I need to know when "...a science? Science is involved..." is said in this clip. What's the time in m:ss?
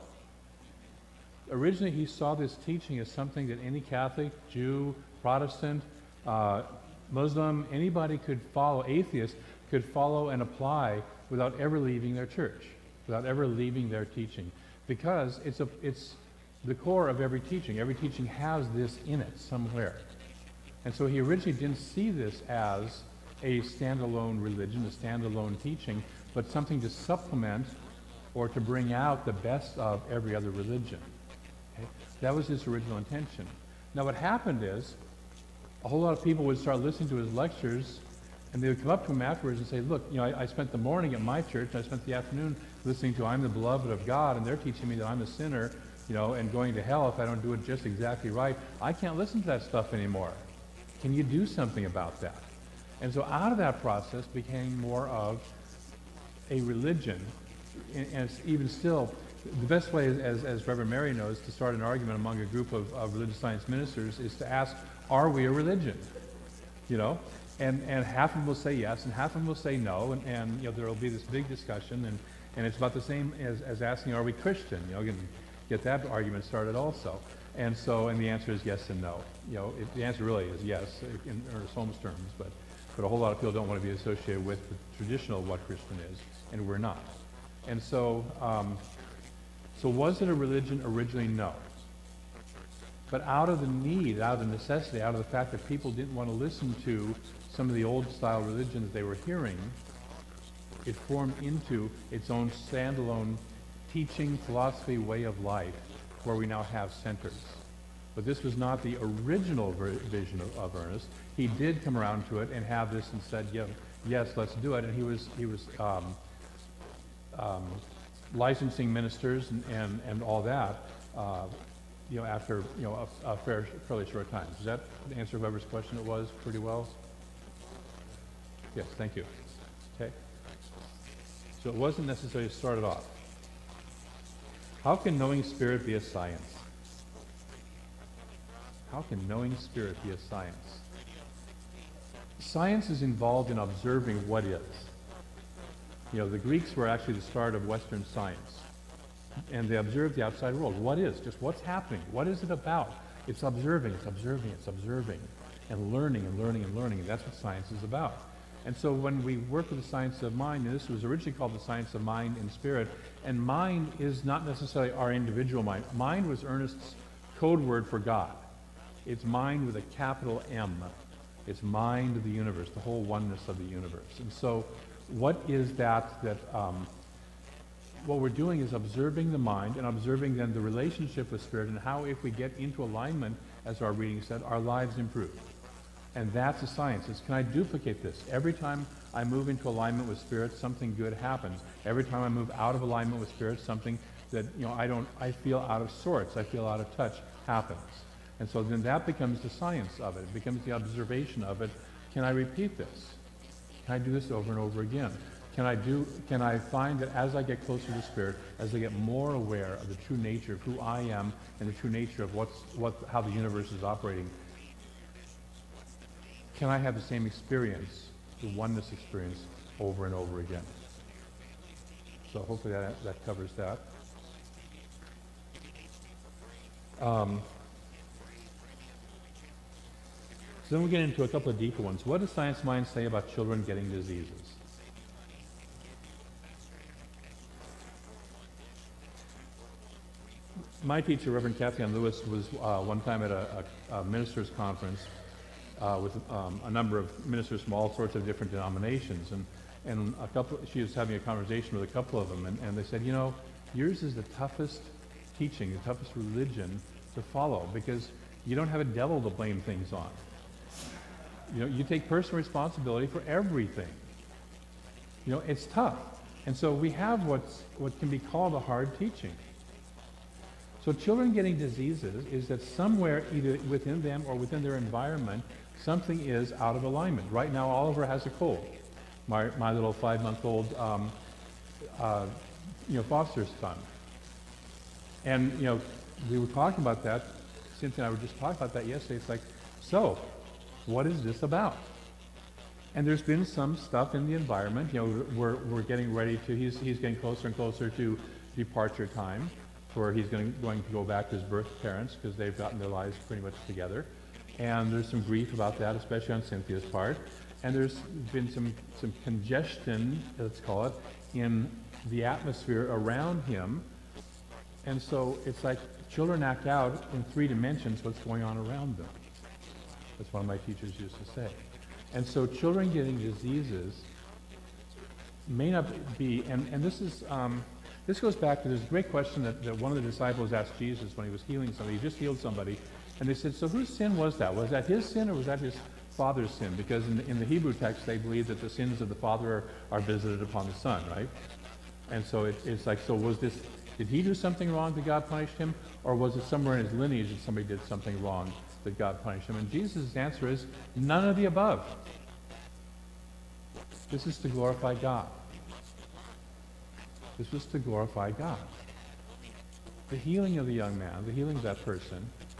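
2:20.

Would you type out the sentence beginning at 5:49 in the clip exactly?
And Jesus' answer is none of the above.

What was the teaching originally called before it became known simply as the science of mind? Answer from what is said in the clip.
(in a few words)
Science of mind and spirit.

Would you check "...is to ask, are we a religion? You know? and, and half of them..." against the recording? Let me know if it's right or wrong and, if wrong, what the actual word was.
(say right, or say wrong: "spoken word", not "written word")
right.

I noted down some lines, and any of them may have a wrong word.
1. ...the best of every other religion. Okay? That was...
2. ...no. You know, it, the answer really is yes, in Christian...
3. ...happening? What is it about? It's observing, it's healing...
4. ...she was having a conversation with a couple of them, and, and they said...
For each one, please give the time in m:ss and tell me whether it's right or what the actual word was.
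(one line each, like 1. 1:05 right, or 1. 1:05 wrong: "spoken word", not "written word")
1. 0:29 right
2. 1:19 wrong: "Ernest", not "Christian"
3. 2:31 wrong: "observing", not "healing"
4. 4:10 right.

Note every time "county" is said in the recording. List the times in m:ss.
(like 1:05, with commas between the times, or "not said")
not said.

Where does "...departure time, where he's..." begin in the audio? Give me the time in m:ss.
4:58.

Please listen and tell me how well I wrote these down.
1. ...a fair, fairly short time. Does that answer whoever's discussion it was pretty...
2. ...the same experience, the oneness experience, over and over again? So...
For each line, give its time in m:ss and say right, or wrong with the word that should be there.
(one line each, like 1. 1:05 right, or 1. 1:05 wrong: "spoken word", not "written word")
1. 2:03 wrong: "question", not "discussion"
2. 3:36 right.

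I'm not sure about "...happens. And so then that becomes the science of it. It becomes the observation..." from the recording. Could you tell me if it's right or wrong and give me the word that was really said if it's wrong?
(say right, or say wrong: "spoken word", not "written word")
right.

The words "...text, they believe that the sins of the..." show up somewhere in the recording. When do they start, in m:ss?
5:37.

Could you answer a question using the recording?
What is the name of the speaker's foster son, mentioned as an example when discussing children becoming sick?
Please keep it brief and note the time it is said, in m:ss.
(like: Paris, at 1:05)
Oliver, at 4:37.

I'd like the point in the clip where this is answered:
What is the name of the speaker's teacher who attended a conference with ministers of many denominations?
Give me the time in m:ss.
4:01.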